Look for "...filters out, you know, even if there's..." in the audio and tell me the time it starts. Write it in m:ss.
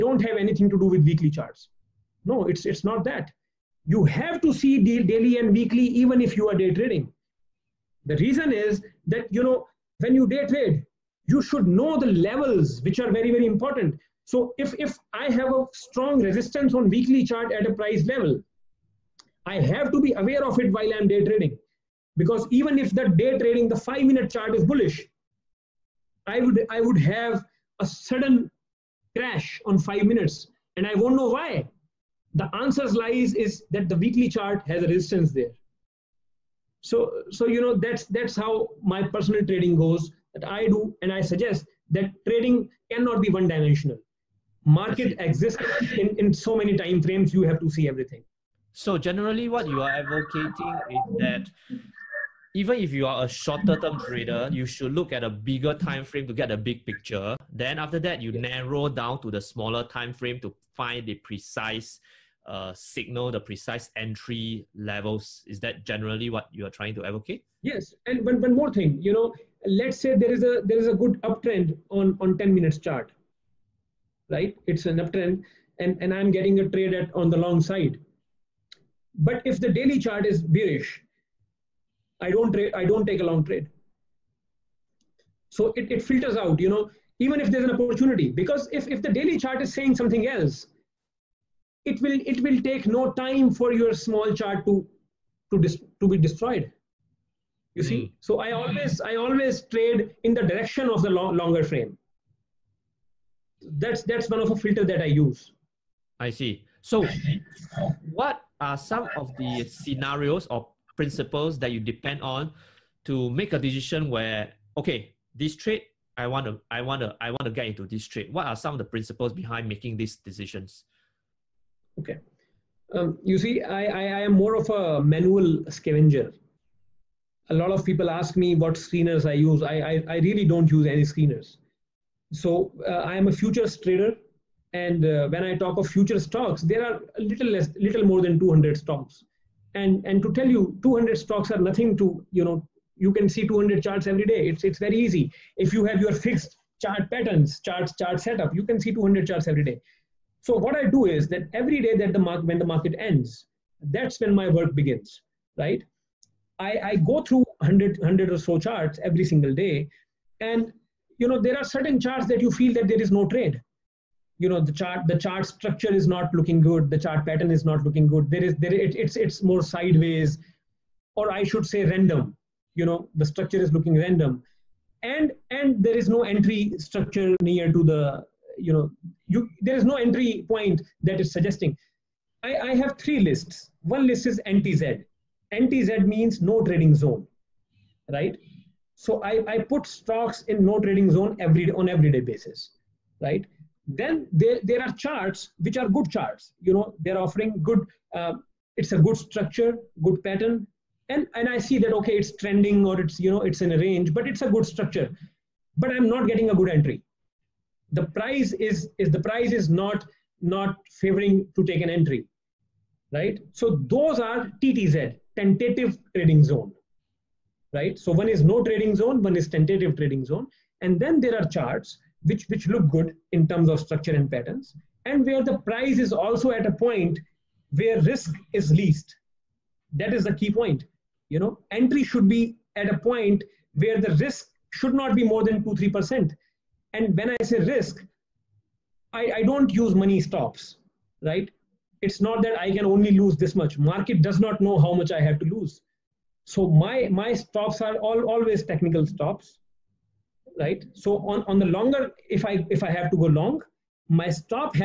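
1:26.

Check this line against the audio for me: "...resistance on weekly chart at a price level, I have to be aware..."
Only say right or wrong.
right.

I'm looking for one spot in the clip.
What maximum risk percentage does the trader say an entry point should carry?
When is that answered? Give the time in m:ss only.
3:55.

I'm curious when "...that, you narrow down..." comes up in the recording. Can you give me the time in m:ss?
0:57.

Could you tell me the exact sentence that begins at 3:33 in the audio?
So those are TTZ, tentative trading zone right?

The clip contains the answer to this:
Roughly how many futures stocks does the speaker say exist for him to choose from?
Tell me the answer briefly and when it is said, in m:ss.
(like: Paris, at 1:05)
a little more than 200, at 2:17.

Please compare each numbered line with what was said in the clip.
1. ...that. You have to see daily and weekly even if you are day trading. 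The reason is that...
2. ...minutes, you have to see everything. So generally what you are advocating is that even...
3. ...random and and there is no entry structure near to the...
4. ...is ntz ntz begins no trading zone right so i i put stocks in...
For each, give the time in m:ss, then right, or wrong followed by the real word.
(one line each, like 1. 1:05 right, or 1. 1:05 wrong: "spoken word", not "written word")
1. 0:03 right
2. 0:47 wrong: "frames", not "minutes"
3. 2:53 right
4. 3:04 wrong: "means", not "begins".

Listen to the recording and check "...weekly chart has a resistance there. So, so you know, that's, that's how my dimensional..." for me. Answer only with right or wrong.
wrong.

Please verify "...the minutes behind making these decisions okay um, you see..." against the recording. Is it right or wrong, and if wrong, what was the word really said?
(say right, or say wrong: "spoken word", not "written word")
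wrong: "principles", not "minutes".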